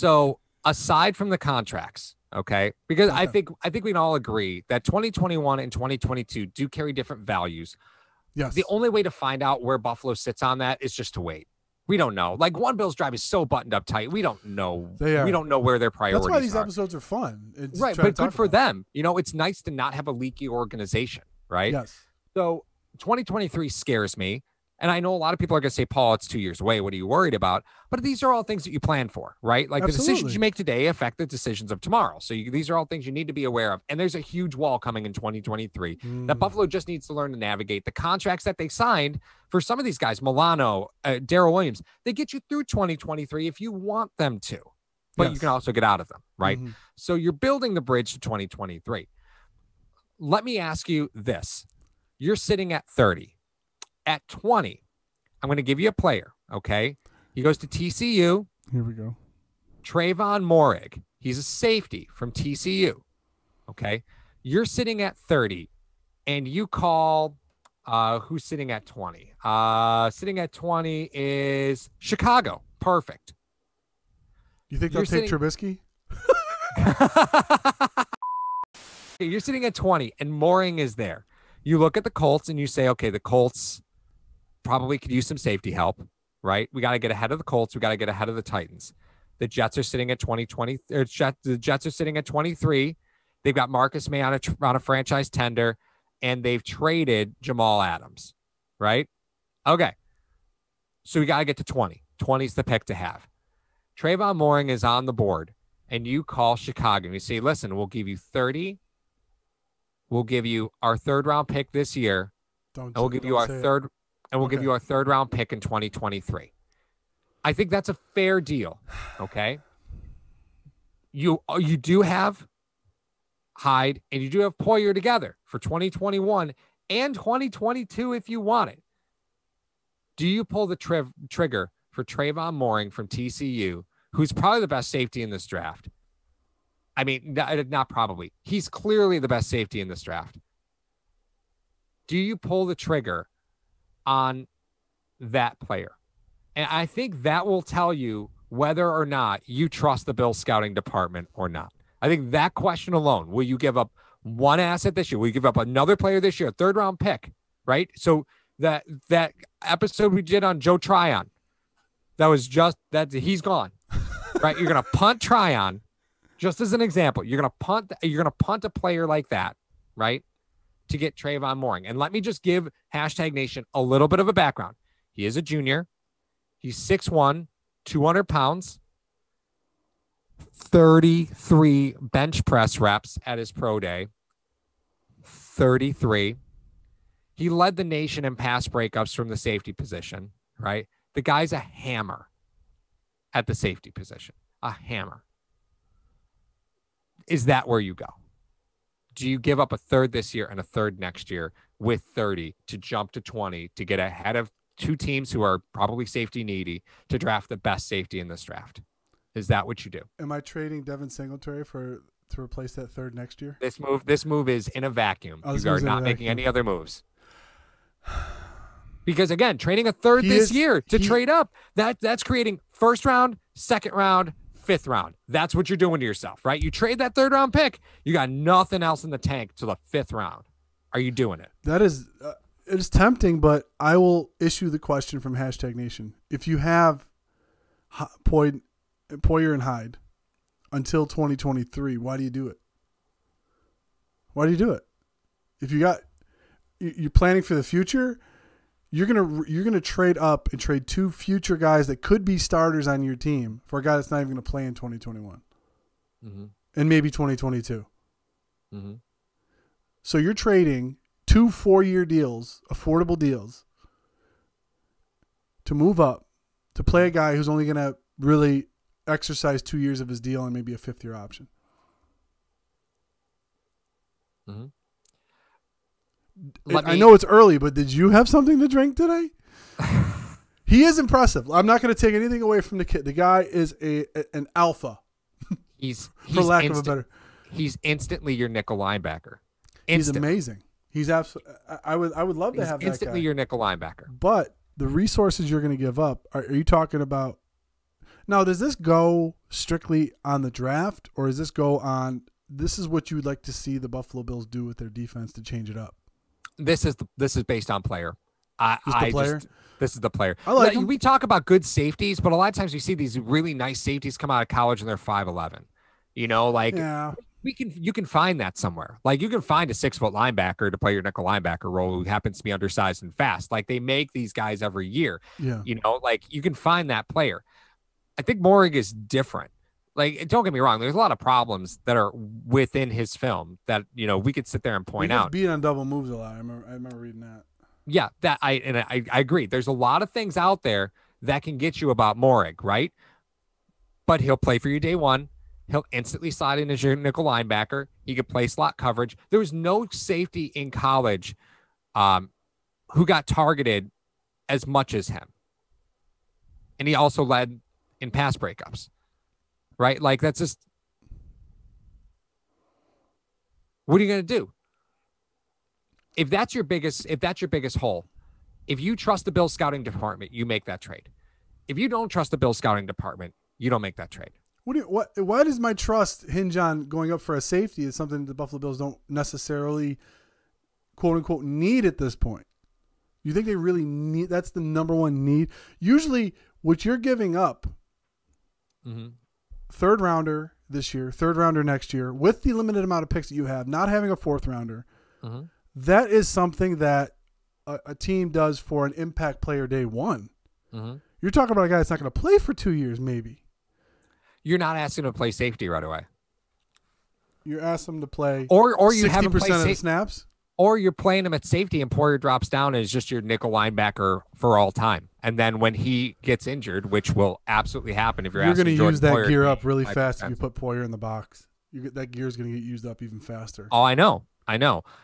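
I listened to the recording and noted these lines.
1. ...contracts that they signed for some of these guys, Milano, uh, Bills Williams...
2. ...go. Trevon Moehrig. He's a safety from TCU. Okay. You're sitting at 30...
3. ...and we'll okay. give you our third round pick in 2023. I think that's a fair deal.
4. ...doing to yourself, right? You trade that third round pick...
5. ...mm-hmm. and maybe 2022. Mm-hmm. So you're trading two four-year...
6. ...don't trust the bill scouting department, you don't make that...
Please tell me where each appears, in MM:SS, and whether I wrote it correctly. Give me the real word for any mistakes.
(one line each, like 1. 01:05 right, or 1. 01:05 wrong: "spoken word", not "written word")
1. 00:37 wrong: "Daryl", not "Bills"
2. 00:58 right
3. 01:54 right
4. 03:45 right
5. 04:16 right
6. 06:11 right.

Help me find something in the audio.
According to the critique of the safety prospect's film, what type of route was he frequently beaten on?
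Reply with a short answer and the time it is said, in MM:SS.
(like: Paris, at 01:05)
Double moves, at 05:35.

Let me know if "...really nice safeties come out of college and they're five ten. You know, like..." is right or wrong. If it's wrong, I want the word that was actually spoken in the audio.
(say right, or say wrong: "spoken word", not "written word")
wrong: "eleven", not "ten".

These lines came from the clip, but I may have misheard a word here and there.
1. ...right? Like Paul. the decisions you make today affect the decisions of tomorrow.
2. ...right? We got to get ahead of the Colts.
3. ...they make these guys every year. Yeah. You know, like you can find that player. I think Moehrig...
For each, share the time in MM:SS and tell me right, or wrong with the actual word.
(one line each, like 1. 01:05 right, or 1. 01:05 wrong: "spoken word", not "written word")
1. 00:29 wrong: "Absolutely", not "Paul"
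2. 01:26 right
3. 05:23 right.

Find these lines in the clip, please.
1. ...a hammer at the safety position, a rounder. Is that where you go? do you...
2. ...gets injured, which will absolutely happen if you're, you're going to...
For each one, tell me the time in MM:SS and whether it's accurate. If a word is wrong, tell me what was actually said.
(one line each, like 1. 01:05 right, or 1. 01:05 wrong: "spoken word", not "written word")
1. 03:11 wrong: "hammer", not "rounder"
2. 06:56 right.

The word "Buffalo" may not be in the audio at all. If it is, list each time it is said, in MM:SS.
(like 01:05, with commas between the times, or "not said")
00:09, 00:36, 05:03, 06:18.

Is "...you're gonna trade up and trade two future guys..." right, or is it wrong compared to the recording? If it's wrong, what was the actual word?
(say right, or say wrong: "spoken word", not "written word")
right.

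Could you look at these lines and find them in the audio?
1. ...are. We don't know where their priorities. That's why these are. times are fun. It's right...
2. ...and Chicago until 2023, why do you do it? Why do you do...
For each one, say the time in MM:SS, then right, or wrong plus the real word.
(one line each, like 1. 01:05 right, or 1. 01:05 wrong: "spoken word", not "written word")
1. 00:15 wrong: "episodes", not "times"
2. 03:59 wrong: "Hyde", not "Chicago".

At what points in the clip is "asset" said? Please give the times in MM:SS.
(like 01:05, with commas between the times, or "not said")
02:34.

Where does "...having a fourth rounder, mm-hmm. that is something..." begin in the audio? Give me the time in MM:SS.
06:33.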